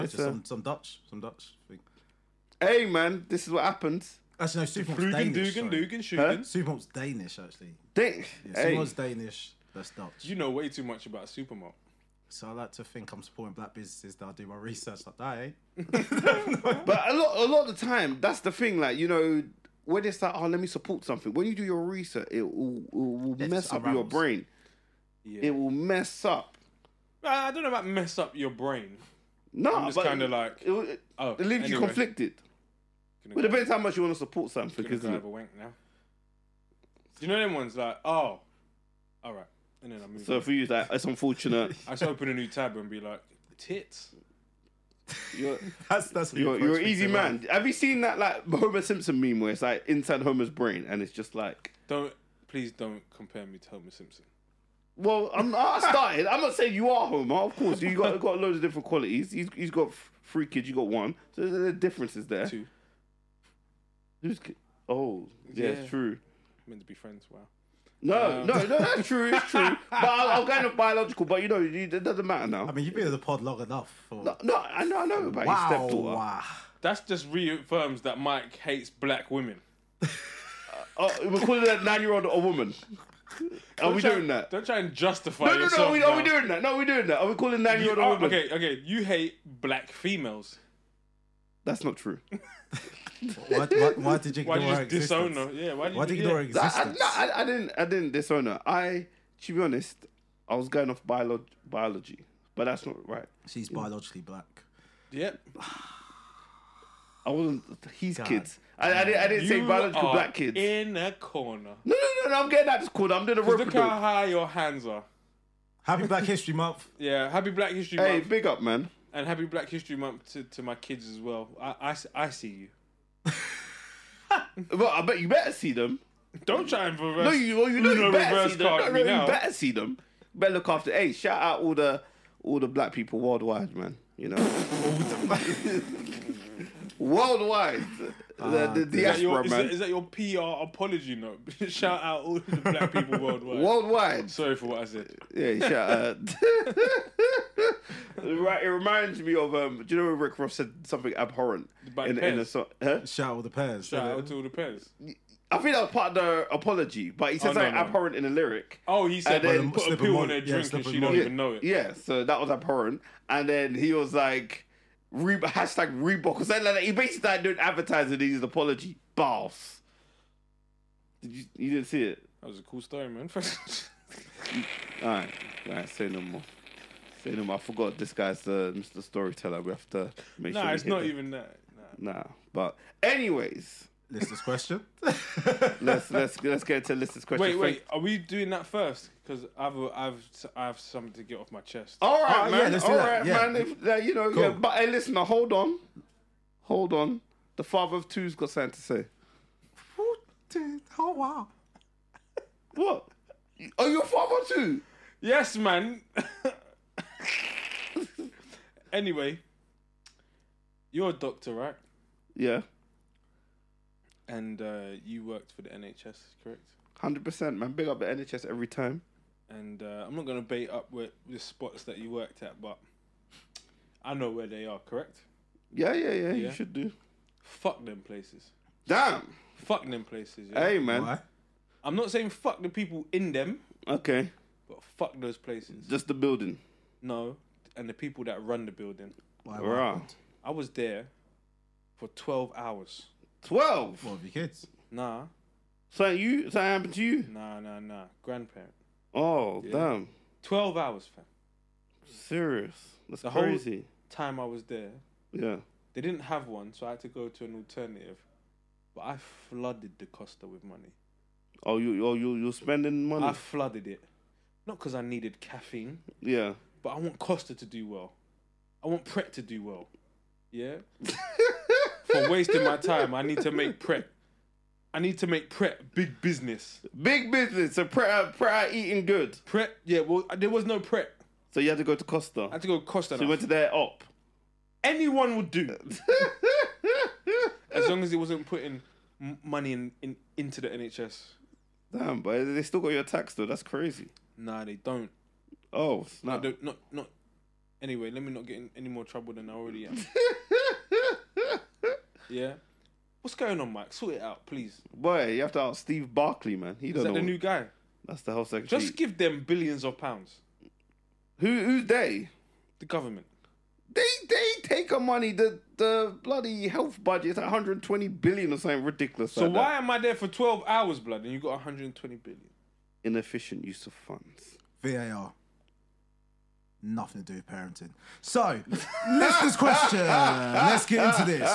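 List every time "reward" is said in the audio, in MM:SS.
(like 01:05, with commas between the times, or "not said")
not said.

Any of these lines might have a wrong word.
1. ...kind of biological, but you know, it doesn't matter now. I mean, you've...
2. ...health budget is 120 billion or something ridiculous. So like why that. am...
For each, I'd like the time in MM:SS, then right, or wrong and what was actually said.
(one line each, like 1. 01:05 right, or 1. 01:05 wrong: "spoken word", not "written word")
1. 01:10 right
2. 05:16 right.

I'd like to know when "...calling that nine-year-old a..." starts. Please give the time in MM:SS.
01:21.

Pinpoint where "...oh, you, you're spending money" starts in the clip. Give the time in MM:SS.
04:22.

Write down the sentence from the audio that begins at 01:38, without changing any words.
I, to be honest, I was going off biolo- biology, but that's not right.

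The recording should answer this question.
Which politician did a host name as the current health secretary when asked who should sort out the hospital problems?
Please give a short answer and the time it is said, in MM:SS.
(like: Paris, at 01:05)
Steve Barclay, at 05:05.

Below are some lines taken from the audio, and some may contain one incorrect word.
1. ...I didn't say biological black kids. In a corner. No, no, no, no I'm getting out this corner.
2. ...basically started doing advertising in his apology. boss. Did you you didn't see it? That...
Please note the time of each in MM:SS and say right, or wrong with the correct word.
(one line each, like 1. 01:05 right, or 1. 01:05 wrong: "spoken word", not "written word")
1. 01:49 right
2. 02:46 right.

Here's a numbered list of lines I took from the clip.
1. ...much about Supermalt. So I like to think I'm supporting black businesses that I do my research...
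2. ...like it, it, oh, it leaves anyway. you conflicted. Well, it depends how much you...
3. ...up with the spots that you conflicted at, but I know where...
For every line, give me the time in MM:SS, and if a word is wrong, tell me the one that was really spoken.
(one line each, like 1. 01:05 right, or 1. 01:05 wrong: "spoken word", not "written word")
1. 00:10 right
2. 00:30 right
3. 03:40 wrong: "worked", not "conflicted".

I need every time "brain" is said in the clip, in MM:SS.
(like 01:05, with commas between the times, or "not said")
00:24, 00:28, 00:50.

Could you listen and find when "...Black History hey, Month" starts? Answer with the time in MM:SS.
01:57.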